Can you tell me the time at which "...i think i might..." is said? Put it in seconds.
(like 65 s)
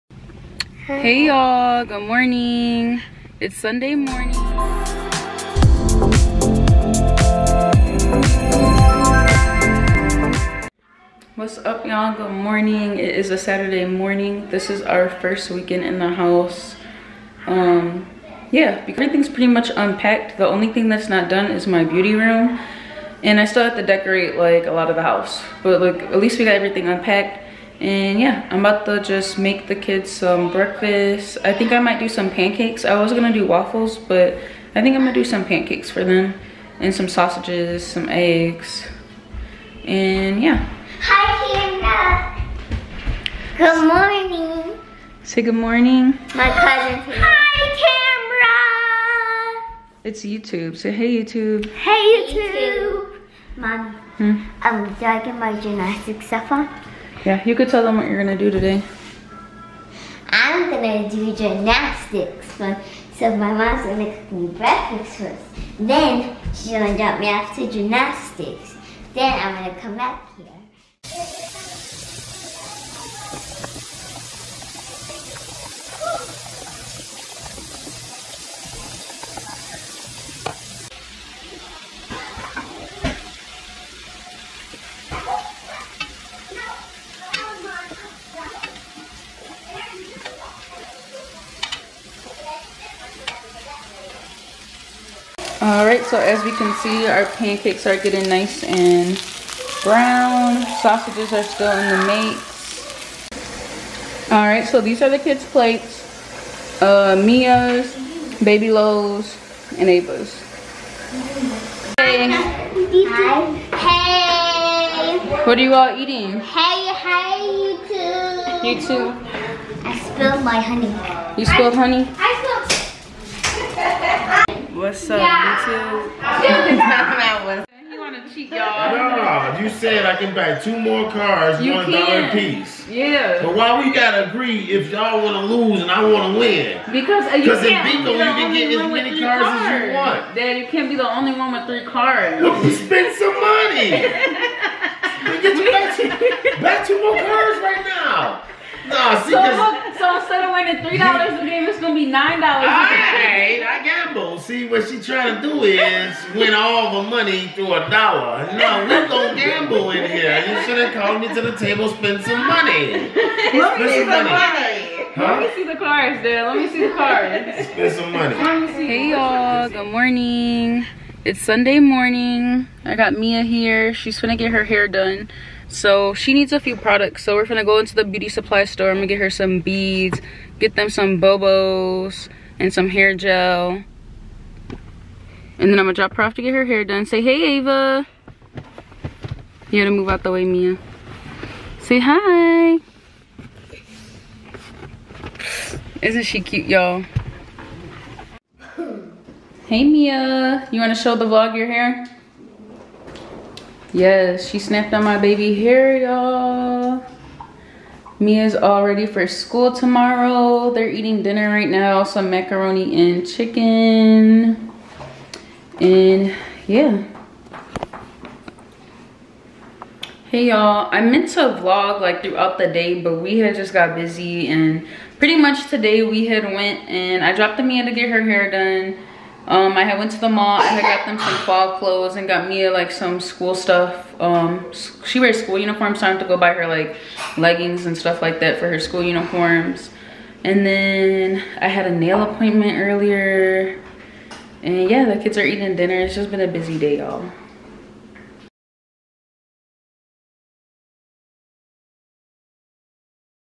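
31 s.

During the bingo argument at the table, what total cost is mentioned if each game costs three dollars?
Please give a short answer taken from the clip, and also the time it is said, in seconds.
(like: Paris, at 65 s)
$9, at 152 s.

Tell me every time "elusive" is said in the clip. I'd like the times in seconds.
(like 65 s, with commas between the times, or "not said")
not said.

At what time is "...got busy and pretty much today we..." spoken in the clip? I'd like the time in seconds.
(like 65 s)
223 s.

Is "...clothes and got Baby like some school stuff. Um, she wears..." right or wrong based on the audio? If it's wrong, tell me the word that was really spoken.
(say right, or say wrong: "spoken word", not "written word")
wrong: "Mia", not "Baby".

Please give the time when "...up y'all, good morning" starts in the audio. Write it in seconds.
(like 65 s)
11 s.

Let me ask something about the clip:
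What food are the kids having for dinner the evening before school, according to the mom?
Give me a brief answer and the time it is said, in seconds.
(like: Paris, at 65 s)
macaroni and chicken, at 212 s.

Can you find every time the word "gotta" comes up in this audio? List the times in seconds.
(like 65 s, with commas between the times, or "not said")
133 s, 189 s.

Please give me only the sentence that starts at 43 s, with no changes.
good morning say good morning my cousin hi camera it's youtube say hey youtube hey youtube mom hmm?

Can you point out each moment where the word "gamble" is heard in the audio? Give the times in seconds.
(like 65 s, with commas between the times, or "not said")
153 s, 159 s.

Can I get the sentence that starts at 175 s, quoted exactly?
So she needs a few products.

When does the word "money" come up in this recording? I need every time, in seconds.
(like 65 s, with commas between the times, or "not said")
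143 s, 157 s, 162 s, 168 s.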